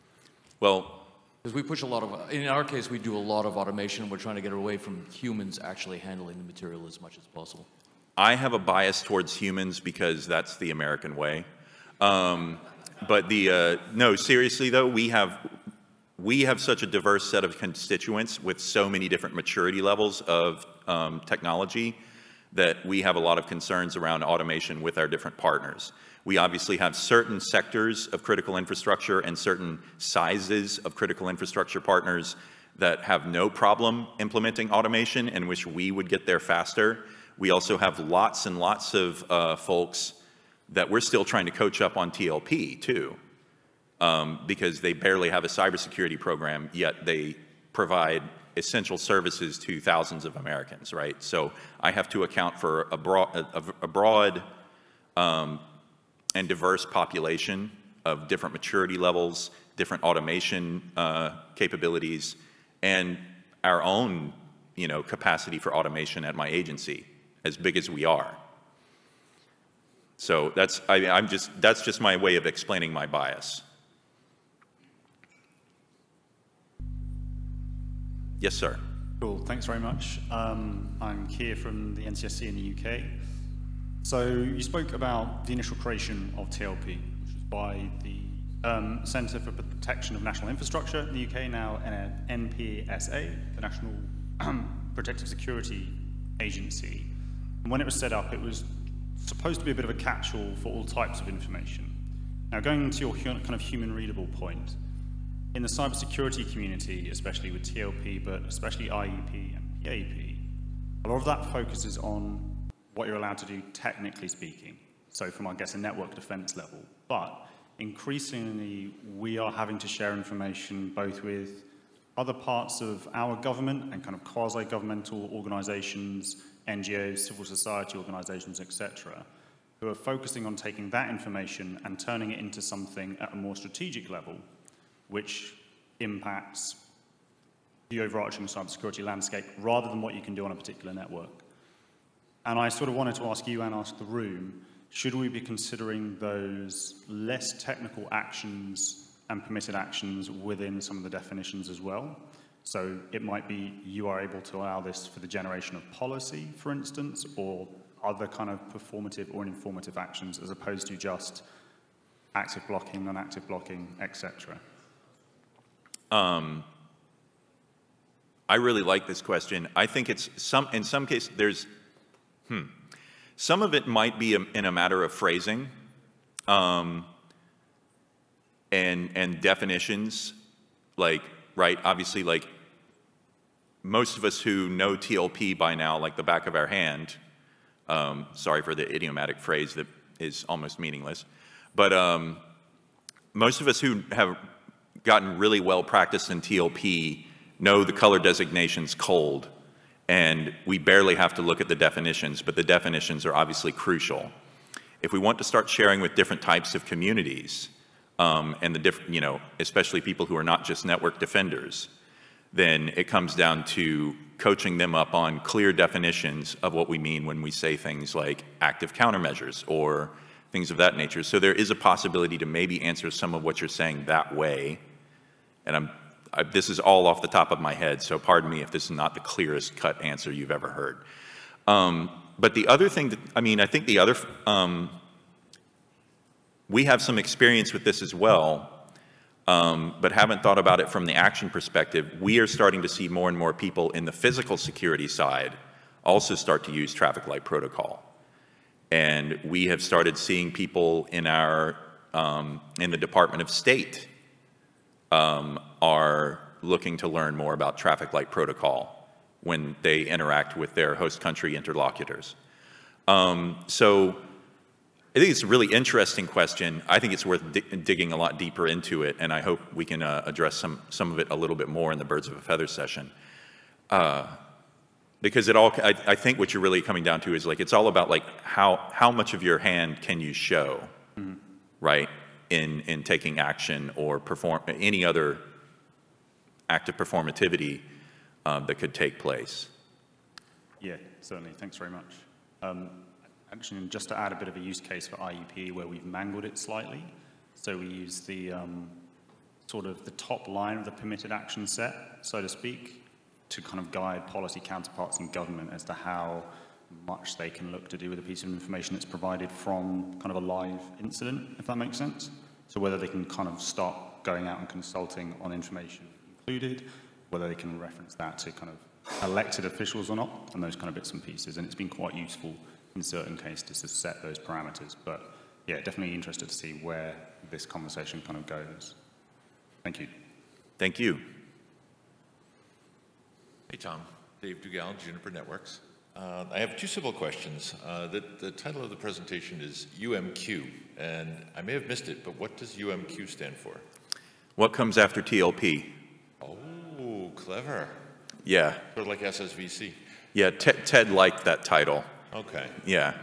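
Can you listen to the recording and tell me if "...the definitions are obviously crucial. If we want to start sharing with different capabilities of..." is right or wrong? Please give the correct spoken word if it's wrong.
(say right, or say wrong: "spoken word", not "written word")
wrong: "types", not "capabilities".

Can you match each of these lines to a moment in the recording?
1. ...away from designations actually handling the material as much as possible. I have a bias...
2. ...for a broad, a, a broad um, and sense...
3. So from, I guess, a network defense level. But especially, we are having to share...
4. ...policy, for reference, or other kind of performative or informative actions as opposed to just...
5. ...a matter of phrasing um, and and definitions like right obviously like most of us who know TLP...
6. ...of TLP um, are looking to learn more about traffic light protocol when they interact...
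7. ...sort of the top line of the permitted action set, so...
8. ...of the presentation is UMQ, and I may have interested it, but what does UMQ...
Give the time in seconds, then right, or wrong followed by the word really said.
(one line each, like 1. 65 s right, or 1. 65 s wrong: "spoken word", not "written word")
1. 4 s wrong: "humans", not "designations"
2. 52 s wrong: "diverse", not "sense"
3. 115 s wrong: "increasingly", not "especially"
4. 155 s wrong: "instance", not "reference"
5. 174 s right
6. 253 s wrong: "State", not "TLP"
7. 299 s right
8. 338 s wrong: "missed", not "interested".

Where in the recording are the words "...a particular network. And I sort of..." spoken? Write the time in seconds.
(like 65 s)
140 s.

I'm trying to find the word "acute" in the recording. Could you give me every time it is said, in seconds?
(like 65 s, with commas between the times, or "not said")
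not said.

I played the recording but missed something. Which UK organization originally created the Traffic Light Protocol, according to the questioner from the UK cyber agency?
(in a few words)
Centre for Protection of National Infrastructure.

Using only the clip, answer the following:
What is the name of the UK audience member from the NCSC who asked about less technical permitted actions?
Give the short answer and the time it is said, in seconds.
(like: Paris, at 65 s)
Keir, at 81 s.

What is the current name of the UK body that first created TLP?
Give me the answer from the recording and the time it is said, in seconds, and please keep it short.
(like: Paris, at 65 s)
NPSA, at 92 s.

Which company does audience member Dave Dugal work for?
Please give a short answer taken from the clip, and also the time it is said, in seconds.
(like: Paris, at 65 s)
Juniper Networks, at 335 s.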